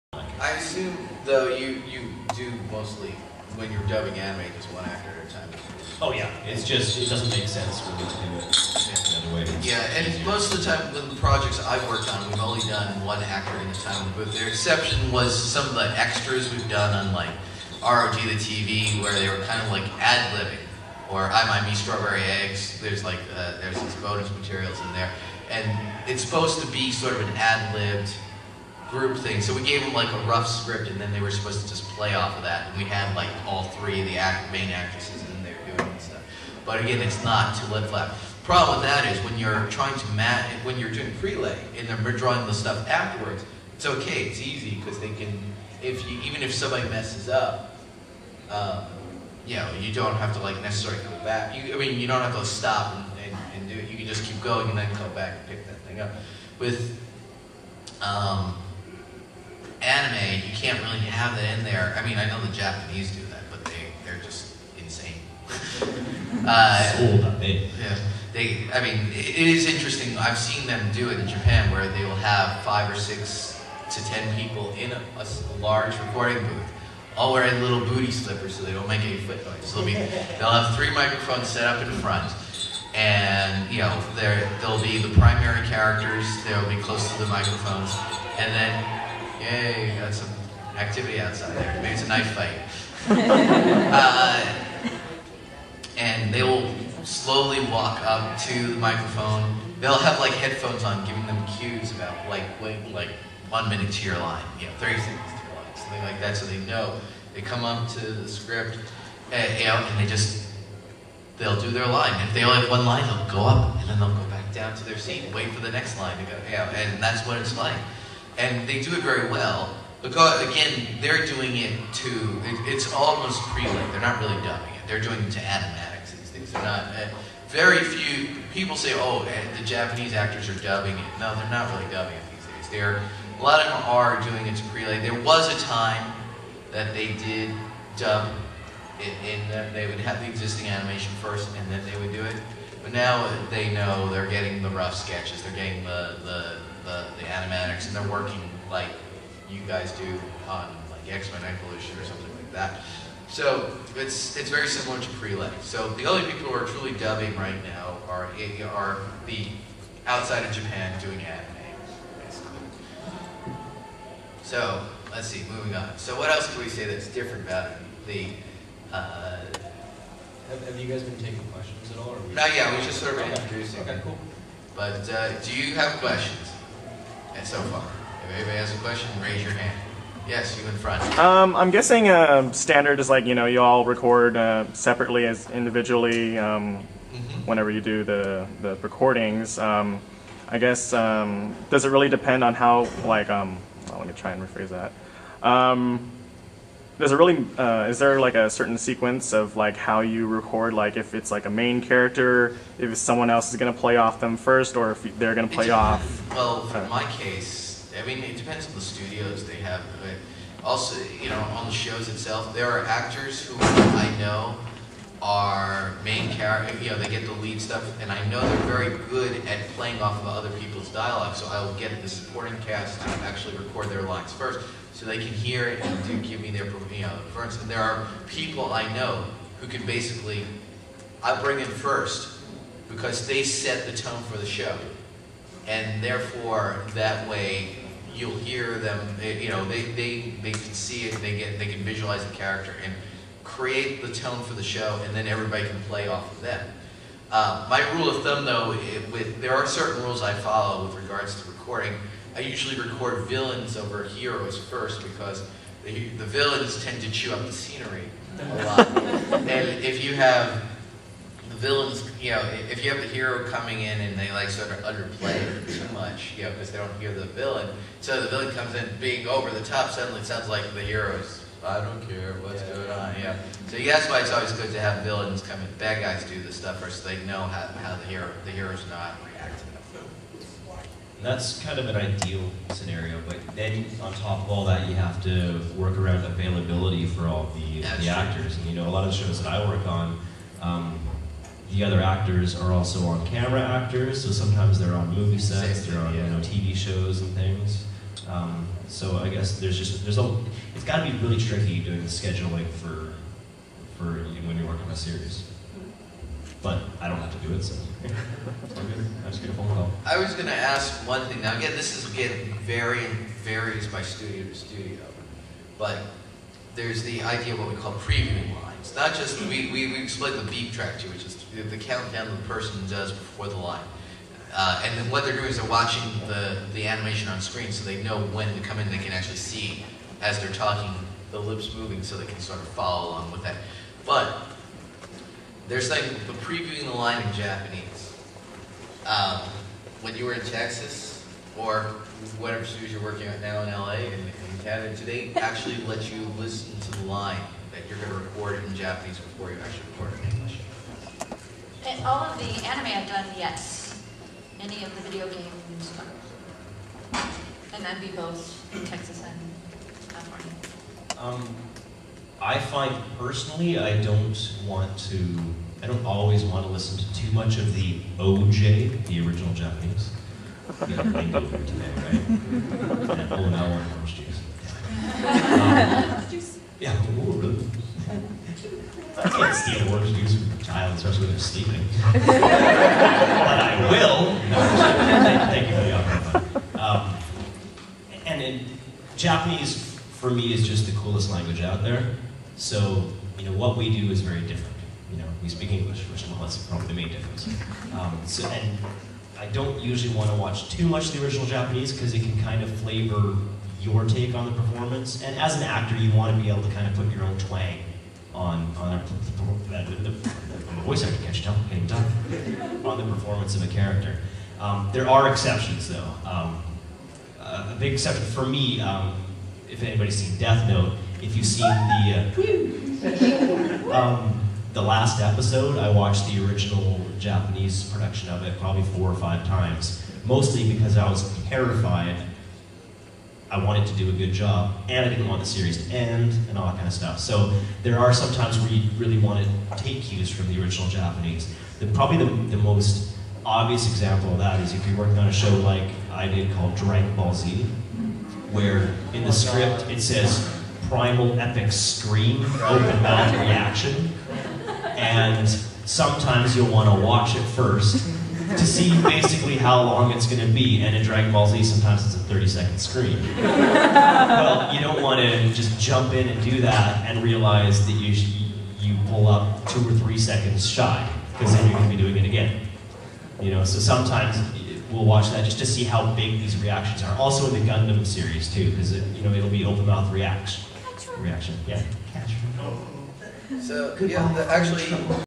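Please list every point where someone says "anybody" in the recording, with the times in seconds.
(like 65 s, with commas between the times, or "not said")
178 s, 419 s.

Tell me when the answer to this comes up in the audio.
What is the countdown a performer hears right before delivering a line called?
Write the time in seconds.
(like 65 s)
320 s.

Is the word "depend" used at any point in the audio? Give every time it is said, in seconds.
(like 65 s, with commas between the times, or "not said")
192 s, 208 s.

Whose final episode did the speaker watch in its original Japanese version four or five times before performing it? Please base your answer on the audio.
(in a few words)
Death Note.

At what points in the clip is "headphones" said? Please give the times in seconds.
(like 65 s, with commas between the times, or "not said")
100 s.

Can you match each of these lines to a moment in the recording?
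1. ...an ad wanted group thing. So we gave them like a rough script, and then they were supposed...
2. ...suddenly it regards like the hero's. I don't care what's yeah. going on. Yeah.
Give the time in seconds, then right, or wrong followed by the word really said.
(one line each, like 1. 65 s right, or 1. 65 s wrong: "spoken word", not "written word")
1. 27 s wrong: "libbed", not "wanted"
2. 269 s wrong: "sounds", not "regards".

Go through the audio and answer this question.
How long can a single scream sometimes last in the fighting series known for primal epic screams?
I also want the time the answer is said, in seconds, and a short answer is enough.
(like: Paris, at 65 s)
30 seconds, at 462 s.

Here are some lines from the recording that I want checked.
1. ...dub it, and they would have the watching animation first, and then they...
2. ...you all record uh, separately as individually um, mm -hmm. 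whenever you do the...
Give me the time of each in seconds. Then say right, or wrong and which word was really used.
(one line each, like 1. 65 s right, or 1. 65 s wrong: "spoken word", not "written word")
1. 137 s wrong: "existing", not "watching"
2. 183 s right.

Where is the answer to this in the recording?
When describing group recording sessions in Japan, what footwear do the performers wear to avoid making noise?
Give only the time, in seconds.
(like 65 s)
77 s.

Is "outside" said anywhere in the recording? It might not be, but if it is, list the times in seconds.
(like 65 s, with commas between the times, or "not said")
91 s, 160 s.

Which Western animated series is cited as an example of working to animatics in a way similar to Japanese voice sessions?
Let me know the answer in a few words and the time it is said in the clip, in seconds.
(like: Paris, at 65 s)
X-Men Evolution, at 151 s.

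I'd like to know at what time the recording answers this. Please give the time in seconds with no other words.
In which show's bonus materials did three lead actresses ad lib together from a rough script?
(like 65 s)
21 s.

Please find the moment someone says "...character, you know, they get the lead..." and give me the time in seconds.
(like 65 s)
216 s.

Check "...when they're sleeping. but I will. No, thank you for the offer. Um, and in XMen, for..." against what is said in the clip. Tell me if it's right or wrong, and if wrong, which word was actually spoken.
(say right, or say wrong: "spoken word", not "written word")
wrong: "Japanese", not "XMen".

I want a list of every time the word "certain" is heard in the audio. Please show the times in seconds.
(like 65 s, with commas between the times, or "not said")
198 s, 249 s.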